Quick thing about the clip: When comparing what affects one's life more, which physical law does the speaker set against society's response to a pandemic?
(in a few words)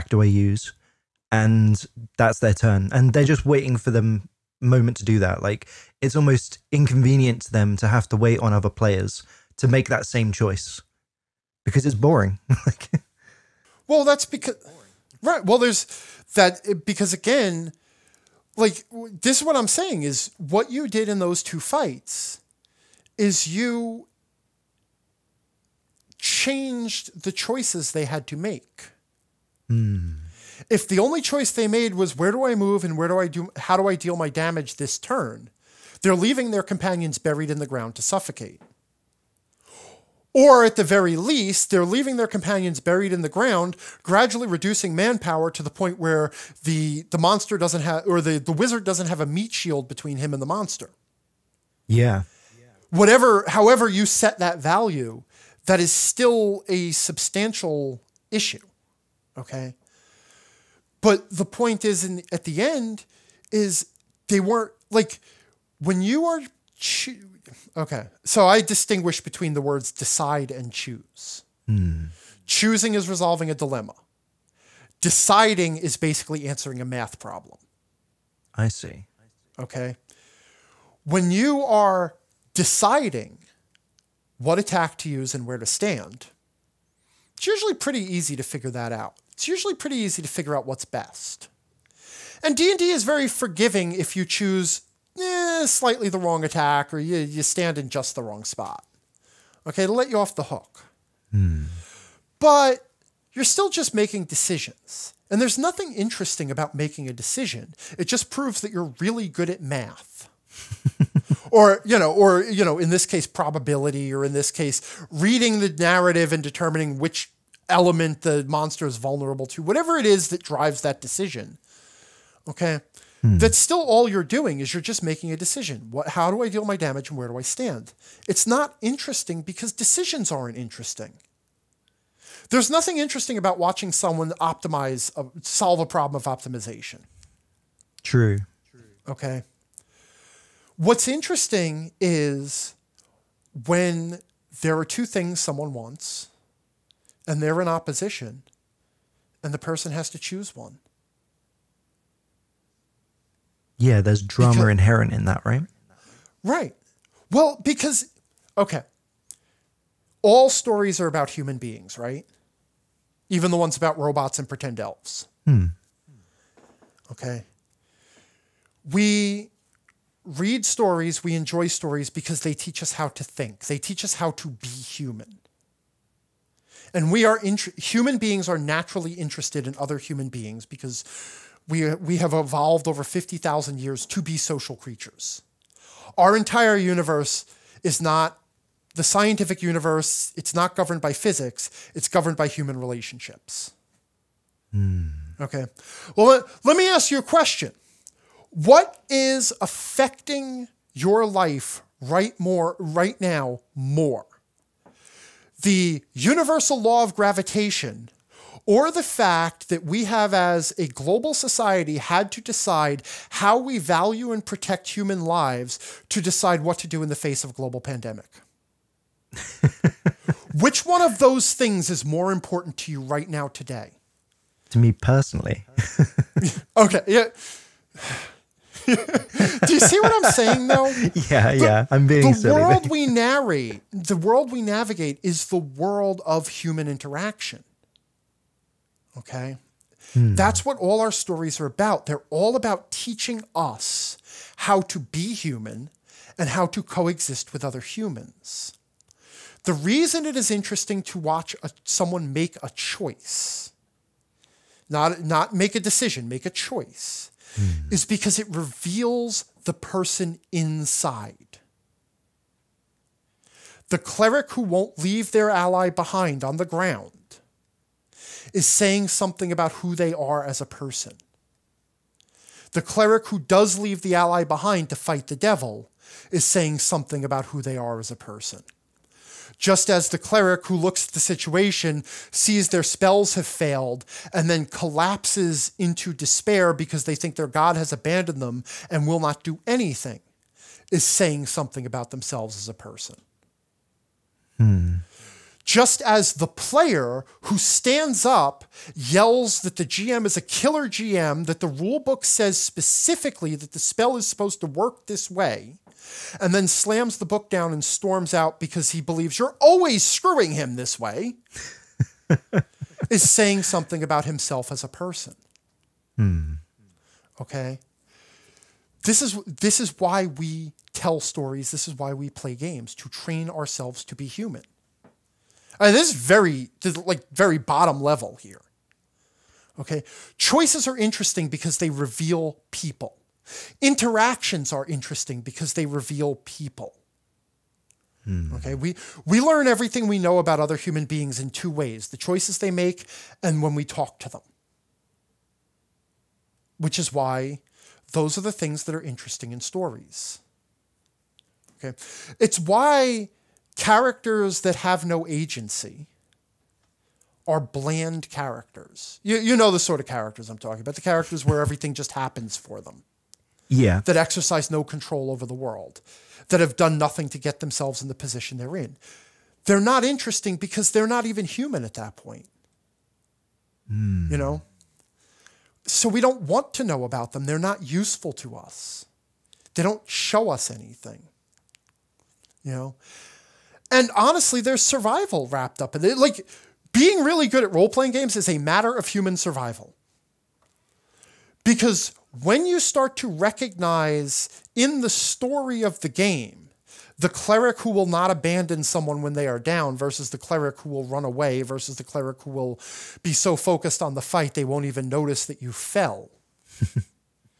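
universal law of gravitation.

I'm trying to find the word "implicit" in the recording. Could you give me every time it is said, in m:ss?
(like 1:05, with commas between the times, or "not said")
not said.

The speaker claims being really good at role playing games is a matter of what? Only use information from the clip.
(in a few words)
human survival.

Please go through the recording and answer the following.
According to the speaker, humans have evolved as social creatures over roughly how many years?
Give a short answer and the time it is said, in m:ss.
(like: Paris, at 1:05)
50,000, at 3:03.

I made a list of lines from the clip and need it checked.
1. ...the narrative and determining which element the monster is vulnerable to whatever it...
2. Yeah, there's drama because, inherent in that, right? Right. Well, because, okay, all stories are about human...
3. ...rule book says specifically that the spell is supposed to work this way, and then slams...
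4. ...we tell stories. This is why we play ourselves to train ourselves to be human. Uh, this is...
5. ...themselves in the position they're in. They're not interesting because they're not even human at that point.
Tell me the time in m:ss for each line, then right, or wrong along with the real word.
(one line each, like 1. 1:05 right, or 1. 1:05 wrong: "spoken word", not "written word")
1. 1:55 right
2. 2:33 right
3. 5:01 right
4. 5:20 wrong: "games", not "ourselves"
5. 6:07 right.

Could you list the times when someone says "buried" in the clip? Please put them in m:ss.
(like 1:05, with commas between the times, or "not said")
0:37, 0:42.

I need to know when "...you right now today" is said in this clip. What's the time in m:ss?
3:42.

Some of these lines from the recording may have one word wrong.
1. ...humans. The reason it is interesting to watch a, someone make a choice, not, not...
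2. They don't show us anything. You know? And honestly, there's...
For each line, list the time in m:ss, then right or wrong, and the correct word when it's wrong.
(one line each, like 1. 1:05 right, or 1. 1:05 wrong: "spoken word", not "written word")
1. 4:07 right
2. 6:19 right.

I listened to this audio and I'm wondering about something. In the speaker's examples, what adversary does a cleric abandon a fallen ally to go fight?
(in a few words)
the devil.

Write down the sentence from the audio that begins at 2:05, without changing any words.
What, how do I deal my damage and where do I stand?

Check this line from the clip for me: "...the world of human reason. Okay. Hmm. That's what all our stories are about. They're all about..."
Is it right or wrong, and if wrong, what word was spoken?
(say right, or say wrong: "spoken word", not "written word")
wrong: "interaction", not "reason".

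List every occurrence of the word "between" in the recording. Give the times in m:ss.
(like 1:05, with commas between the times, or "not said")
0:49, 1:09.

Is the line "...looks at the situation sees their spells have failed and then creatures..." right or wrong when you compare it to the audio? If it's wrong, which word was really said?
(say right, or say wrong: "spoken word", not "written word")
wrong: "collapses", not "creatures".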